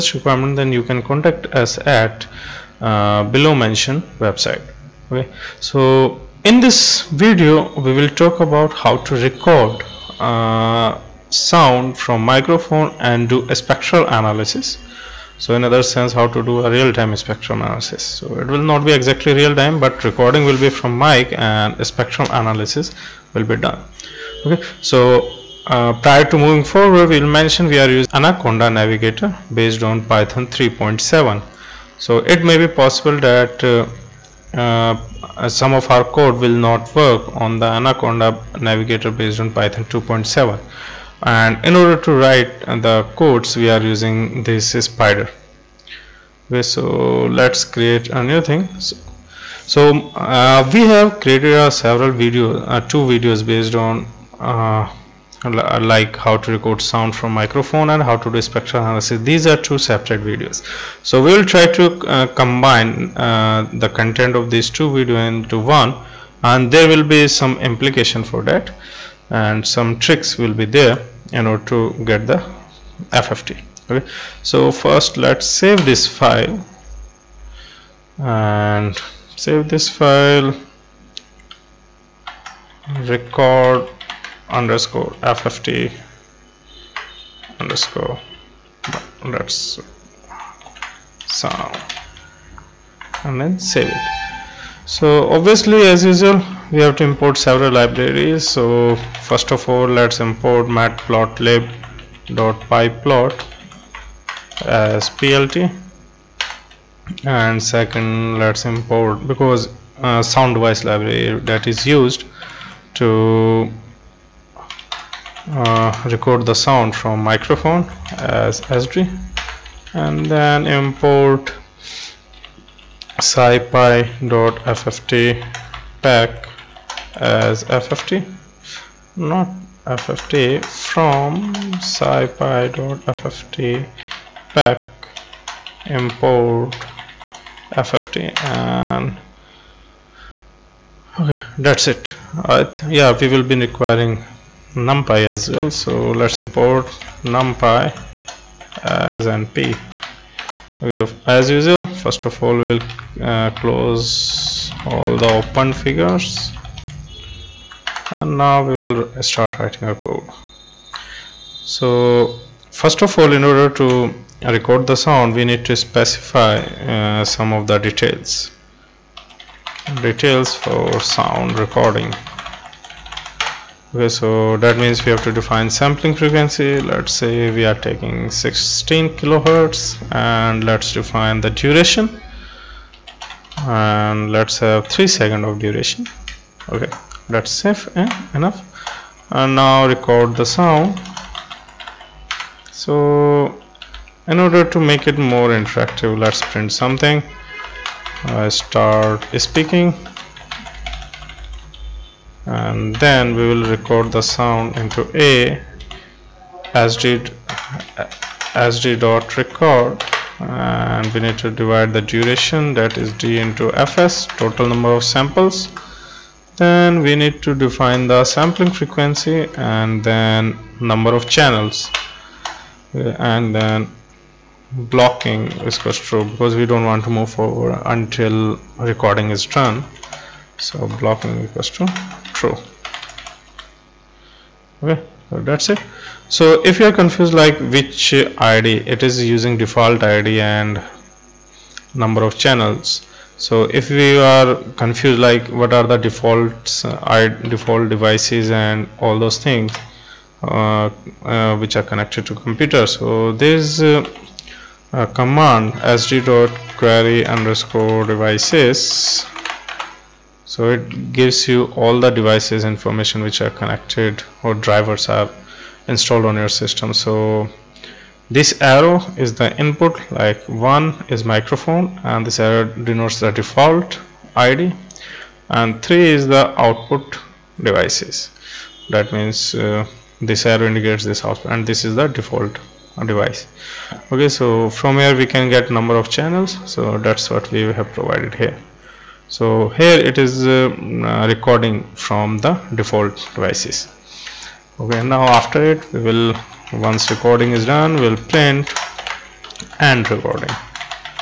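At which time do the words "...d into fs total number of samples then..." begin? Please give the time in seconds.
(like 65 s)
213 s.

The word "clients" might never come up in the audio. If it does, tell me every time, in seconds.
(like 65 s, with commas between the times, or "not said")
not said.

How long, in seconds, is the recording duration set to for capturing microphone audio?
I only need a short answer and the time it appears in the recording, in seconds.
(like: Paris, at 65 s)
3, at 184 s.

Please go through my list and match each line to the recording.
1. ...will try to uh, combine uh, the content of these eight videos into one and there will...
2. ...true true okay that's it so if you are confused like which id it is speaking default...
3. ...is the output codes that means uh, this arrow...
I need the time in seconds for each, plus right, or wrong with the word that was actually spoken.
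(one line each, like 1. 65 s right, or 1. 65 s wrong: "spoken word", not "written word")
1. 61 s wrong: "two", not "eight"
2. 231 s wrong: "using", not "speaking"
3. 276 s wrong: "devices", not "codes".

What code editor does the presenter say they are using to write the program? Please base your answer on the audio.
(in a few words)
Spyder.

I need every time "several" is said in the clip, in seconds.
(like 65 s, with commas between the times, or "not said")
51 s, 97 s.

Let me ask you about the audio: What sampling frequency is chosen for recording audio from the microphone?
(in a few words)
16 kilohertz.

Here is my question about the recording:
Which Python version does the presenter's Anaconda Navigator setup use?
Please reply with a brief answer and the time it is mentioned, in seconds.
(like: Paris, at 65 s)
3.7, at 30 s.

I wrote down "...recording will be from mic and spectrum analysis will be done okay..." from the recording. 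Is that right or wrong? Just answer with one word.
right.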